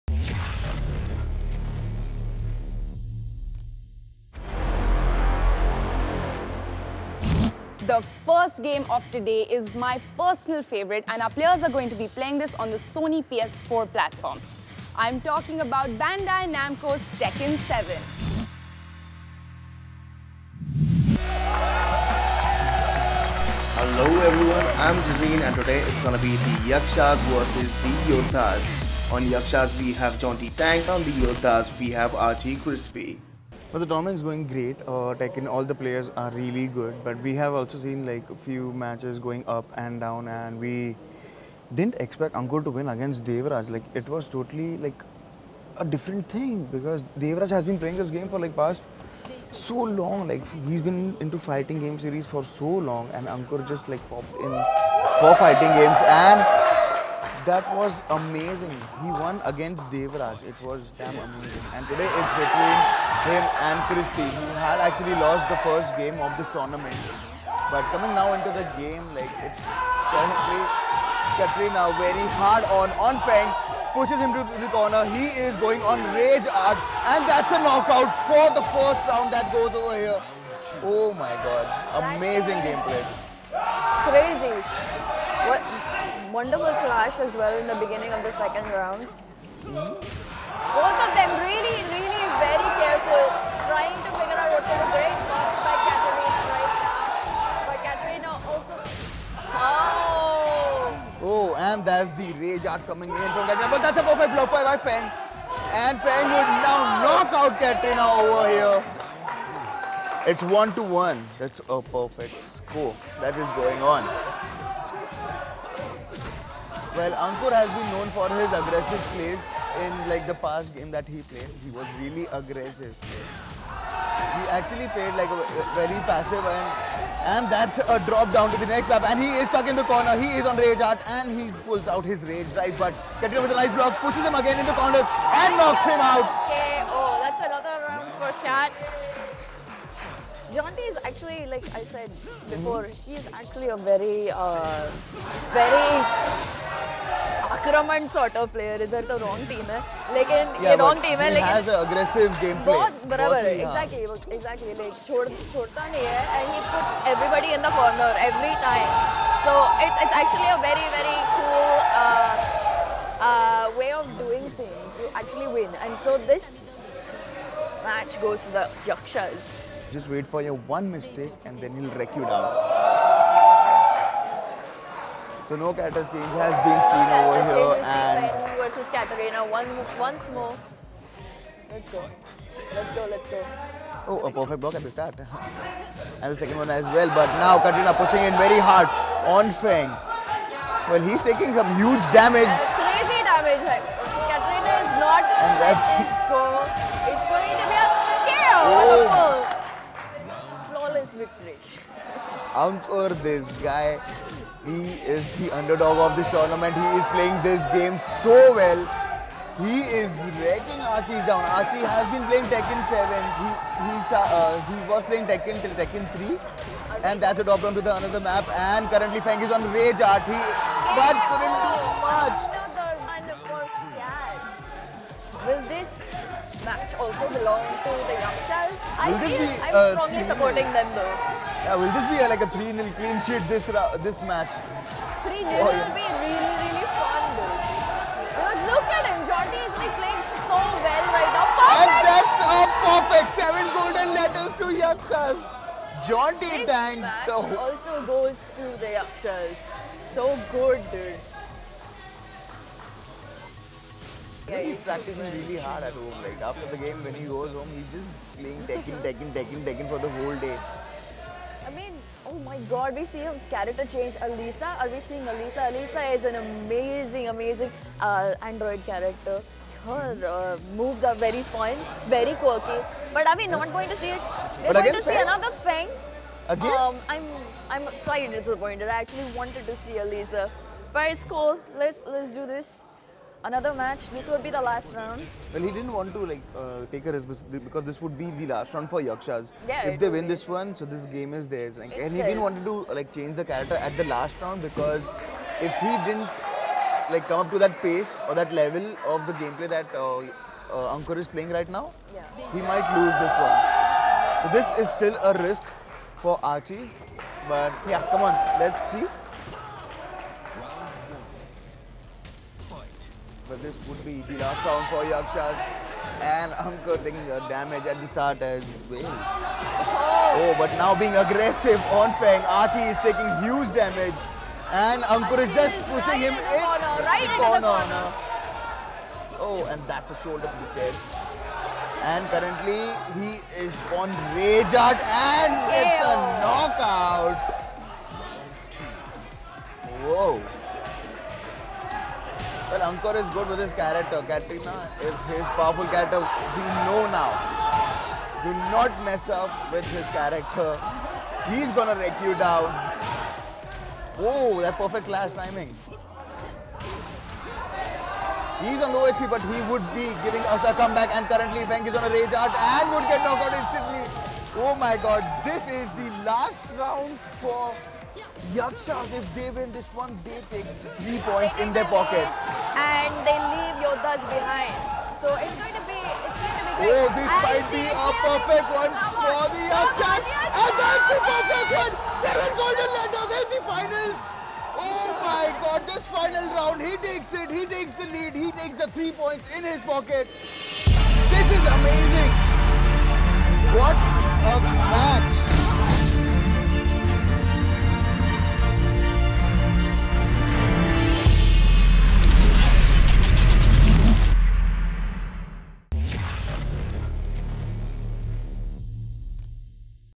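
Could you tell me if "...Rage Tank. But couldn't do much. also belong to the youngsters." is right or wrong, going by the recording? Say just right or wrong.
wrong.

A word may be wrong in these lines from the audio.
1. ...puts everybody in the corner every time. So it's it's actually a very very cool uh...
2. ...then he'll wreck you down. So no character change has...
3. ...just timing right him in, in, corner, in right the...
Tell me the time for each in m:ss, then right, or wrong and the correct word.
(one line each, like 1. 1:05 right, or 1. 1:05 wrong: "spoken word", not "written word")
1. 2:36 right
2. 2:51 right
3. 5:25 wrong: "pushing", not "timing".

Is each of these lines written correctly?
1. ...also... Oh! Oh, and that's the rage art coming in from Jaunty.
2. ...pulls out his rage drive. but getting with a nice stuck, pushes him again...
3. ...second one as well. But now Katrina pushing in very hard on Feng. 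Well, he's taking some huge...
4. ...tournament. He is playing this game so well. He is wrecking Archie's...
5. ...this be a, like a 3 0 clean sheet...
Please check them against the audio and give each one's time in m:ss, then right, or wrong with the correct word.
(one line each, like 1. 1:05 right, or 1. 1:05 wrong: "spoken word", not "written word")
1. 1:38 wrong: "Katarina", not "Jaunty"
2. 2:11 wrong: "block", not "stuck"
3. 3:06 right
4. 3:26 right
5. 3:51 right.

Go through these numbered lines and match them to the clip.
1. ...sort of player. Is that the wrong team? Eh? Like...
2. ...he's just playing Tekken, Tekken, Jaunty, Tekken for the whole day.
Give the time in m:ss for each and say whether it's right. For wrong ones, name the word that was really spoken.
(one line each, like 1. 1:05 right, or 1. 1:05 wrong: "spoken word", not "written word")
1. 2:28 right
2. 4:17 wrong: "Tekken", not "Jaunty".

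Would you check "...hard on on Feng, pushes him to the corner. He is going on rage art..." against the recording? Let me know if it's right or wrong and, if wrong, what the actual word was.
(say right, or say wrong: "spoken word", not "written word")
right.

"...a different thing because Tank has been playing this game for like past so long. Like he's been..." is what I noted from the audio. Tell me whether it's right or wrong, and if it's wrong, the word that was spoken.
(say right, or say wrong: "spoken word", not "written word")
wrong: "Devraj", not "Tank".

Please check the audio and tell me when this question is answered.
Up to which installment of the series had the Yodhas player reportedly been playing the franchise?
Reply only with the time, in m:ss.
3:35.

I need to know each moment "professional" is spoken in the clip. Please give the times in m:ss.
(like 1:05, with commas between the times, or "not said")
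not said.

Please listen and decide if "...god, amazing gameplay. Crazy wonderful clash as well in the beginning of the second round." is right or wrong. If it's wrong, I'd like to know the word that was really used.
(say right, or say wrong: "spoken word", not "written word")
right.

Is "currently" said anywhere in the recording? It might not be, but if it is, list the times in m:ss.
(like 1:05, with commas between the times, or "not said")
3:38, 5:32, 6:01.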